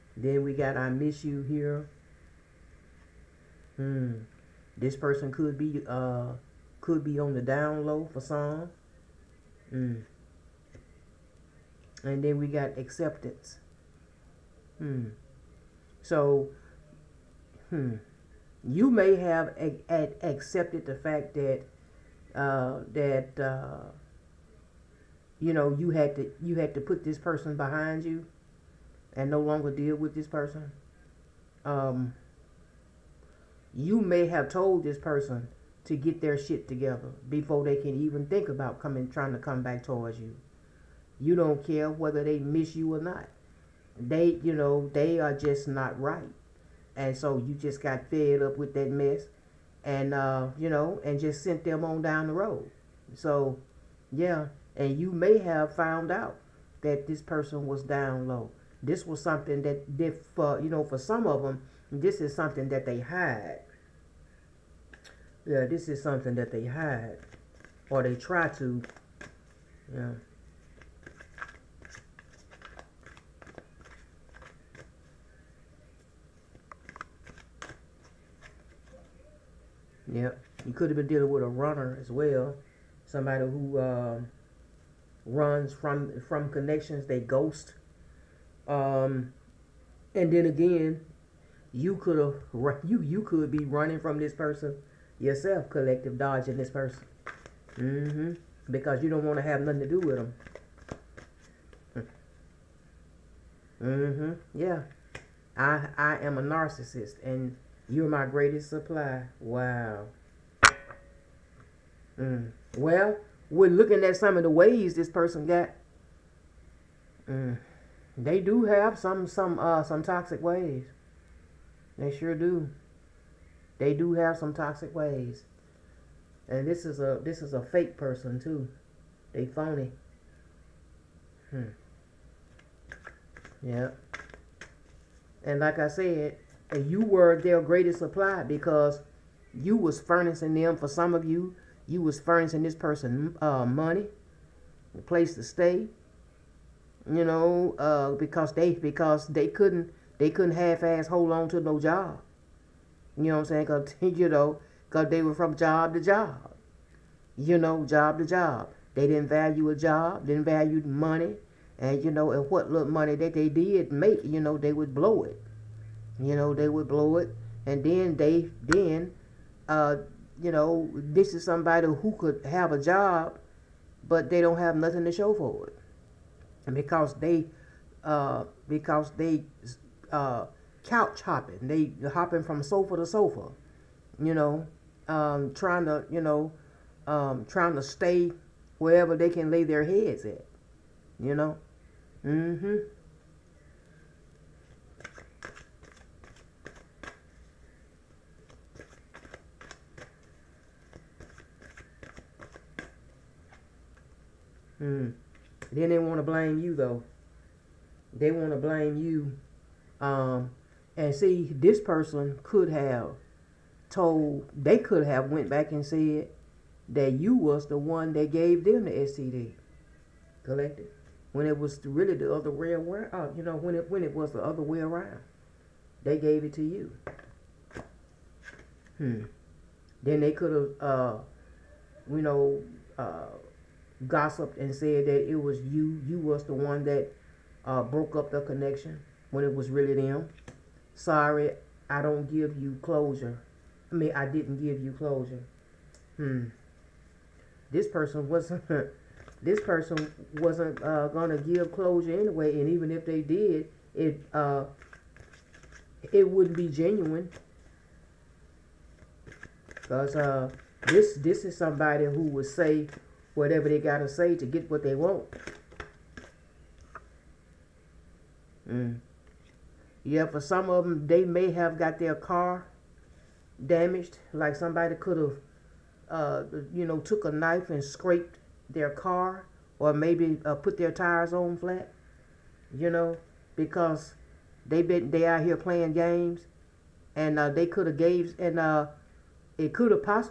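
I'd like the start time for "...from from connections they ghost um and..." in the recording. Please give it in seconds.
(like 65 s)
85 s.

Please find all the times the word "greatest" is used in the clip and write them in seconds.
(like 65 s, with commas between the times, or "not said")
108 s, 137 s.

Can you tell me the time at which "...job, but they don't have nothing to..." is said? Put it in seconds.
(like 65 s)
172 s.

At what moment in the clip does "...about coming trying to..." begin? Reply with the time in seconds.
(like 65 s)
38 s.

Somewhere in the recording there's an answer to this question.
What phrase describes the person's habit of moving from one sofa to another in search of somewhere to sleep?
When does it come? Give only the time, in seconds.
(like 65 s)
180 s.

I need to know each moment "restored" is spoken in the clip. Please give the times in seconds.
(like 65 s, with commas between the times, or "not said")
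not said.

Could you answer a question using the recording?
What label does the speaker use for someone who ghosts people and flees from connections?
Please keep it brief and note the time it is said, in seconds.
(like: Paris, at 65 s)
runner, at 81 s.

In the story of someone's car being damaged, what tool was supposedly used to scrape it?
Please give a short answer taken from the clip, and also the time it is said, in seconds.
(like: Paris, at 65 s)
knife, at 277 s.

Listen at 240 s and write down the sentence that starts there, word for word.
Sorry, I don't give you closure.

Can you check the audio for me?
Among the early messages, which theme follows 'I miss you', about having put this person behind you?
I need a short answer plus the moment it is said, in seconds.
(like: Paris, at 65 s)
acceptance, at 12 s.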